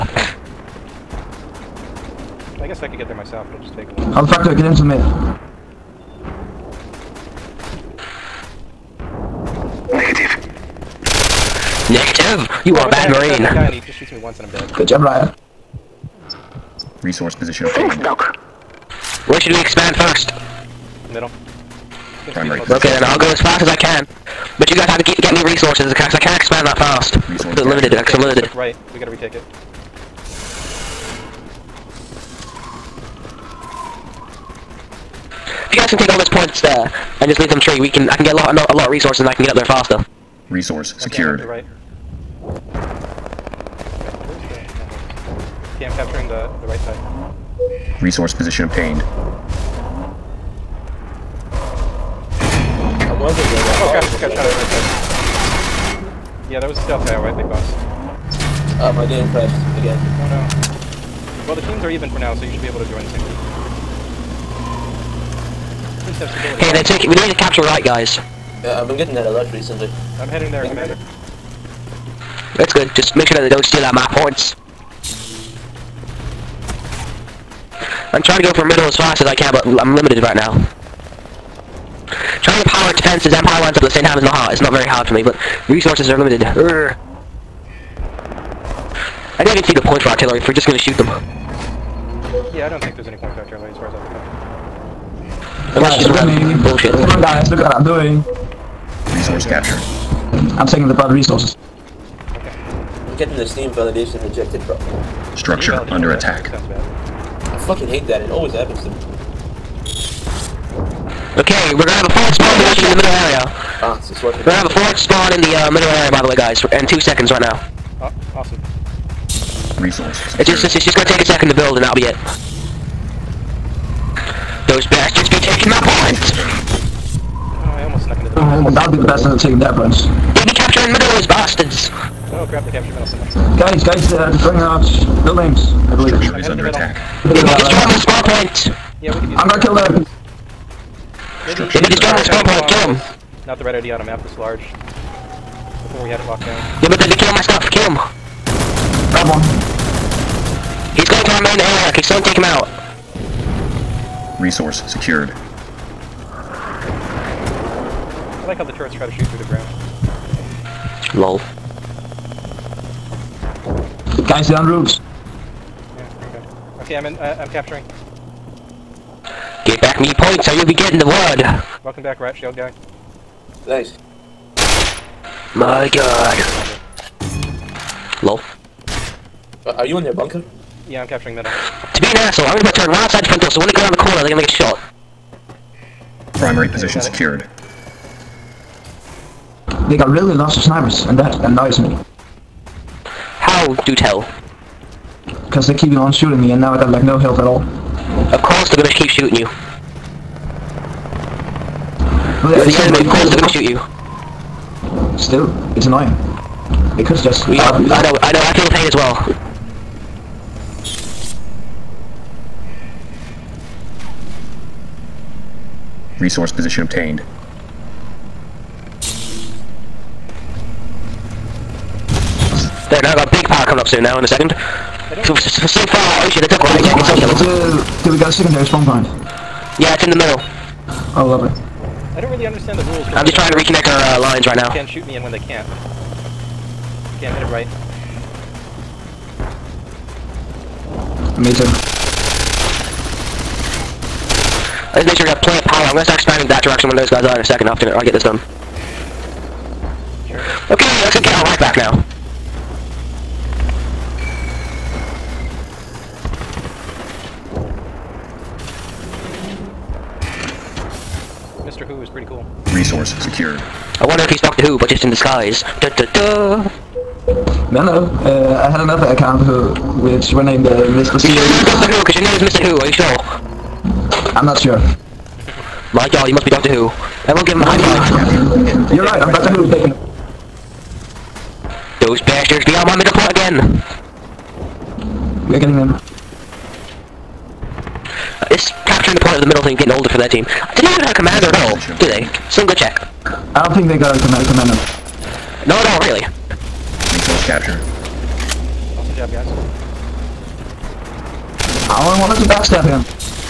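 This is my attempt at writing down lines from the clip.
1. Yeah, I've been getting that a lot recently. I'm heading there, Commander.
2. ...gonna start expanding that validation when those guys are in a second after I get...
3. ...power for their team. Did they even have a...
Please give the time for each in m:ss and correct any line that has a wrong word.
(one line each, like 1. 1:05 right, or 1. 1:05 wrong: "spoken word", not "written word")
1. 1:08 right
2. 4:05 wrong: "direction", not "validation"
3. 4:49 wrong: "older", not "power".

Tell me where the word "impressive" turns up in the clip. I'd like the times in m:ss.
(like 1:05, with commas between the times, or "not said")
not said.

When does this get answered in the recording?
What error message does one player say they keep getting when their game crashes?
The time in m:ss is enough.
1:43.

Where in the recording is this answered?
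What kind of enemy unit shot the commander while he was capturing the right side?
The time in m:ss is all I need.
0:56.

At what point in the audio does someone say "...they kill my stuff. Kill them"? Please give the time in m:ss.
2:27.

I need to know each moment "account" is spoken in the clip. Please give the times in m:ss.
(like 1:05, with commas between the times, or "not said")
4:29.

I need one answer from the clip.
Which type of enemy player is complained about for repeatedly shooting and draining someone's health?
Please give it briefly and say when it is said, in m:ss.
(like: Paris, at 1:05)
Snipers, at 3:10.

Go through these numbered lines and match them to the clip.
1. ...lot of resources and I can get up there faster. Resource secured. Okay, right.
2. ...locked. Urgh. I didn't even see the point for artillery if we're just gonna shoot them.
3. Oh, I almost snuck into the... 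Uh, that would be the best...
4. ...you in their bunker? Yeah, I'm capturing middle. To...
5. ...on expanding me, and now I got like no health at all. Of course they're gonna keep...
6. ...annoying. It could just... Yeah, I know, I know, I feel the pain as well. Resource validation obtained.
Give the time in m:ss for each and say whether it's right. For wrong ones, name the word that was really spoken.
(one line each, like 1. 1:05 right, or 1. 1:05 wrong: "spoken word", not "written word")
1. 0:38 right
2. 1:26 wrong: "limited", not "locked"
3. 2:07 right
4. 2:59 right
5. 3:15 wrong: "shooting", not "expanding"
6. 3:25 wrong: "position", not "validation".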